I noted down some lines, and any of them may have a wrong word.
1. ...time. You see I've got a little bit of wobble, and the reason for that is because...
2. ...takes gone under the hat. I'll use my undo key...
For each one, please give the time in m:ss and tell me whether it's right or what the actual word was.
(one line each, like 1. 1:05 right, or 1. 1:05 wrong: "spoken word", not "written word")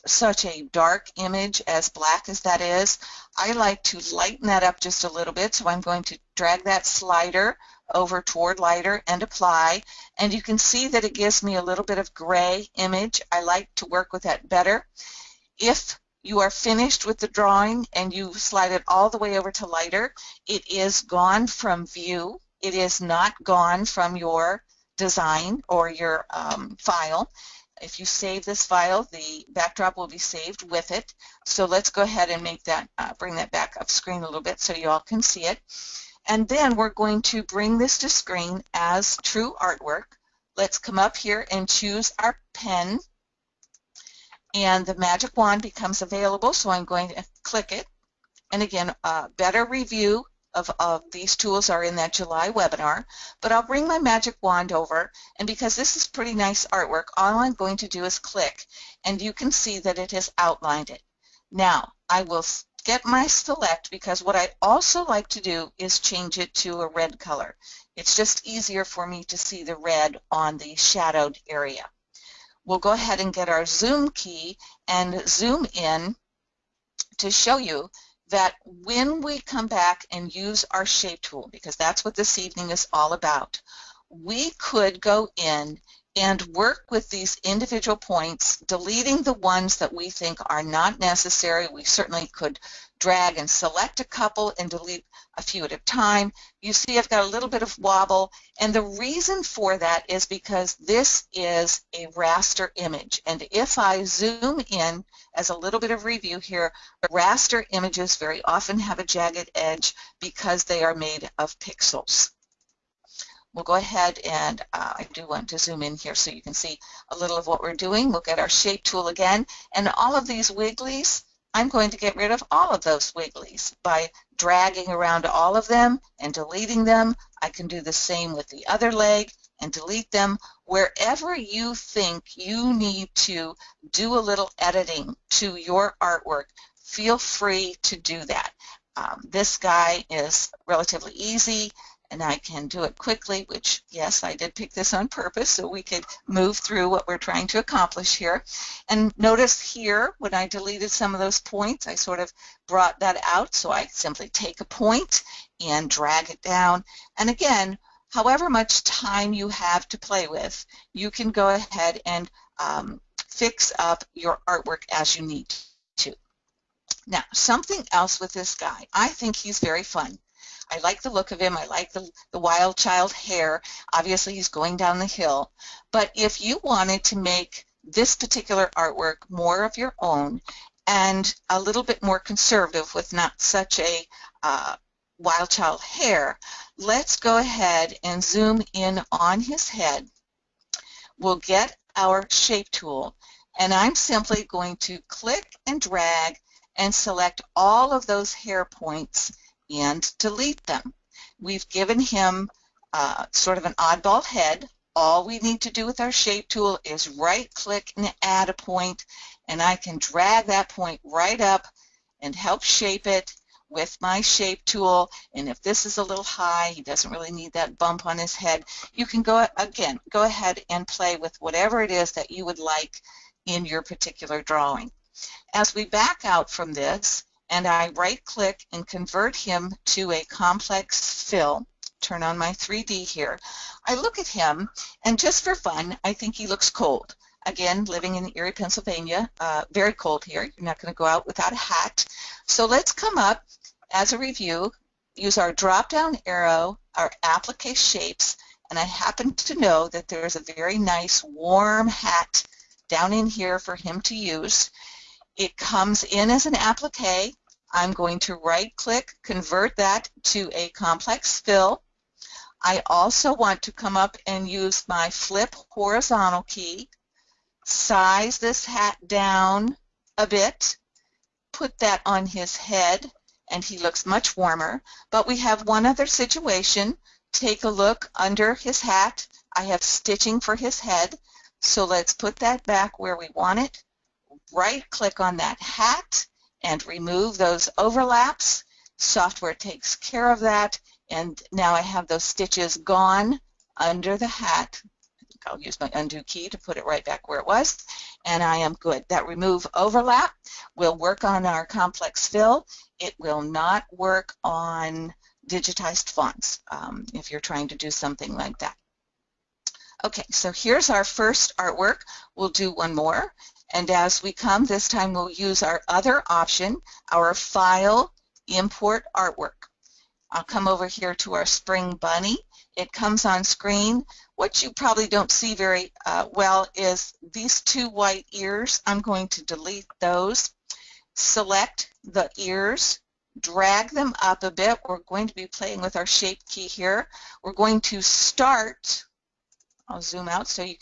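1. 1:35 right
2. 4:52 wrong: "stitches", not "takes".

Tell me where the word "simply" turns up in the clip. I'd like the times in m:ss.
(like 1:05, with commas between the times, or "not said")
2:33, 3:13.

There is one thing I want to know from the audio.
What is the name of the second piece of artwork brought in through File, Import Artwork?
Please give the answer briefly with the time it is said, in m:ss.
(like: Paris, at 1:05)
Spring Bunny, at 5:21.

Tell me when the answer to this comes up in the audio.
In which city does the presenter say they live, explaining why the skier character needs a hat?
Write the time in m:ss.
3:58.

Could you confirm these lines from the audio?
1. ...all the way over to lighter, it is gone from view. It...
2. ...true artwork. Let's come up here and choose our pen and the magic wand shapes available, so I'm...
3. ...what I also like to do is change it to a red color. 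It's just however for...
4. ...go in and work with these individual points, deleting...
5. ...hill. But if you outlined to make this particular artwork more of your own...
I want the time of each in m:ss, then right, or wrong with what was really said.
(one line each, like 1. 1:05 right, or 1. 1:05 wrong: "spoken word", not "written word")
1. 0:18 right
2. 0:39 wrong: "becomes", not "shapes"
3. 1:04 wrong: "easier", not "however"
4. 1:25 right
5. 2:55 wrong: "wanted", not "outlined".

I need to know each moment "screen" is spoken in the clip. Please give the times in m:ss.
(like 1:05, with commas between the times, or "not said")
0:33, 0:38, 5:23.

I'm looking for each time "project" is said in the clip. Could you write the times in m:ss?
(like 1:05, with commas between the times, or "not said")
not said.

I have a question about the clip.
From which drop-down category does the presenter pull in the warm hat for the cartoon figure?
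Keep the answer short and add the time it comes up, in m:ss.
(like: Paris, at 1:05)
Applique shapes, at 4:07.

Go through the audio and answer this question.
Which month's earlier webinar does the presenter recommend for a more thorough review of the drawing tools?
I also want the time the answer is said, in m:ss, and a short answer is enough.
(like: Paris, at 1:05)
July, at 0:52.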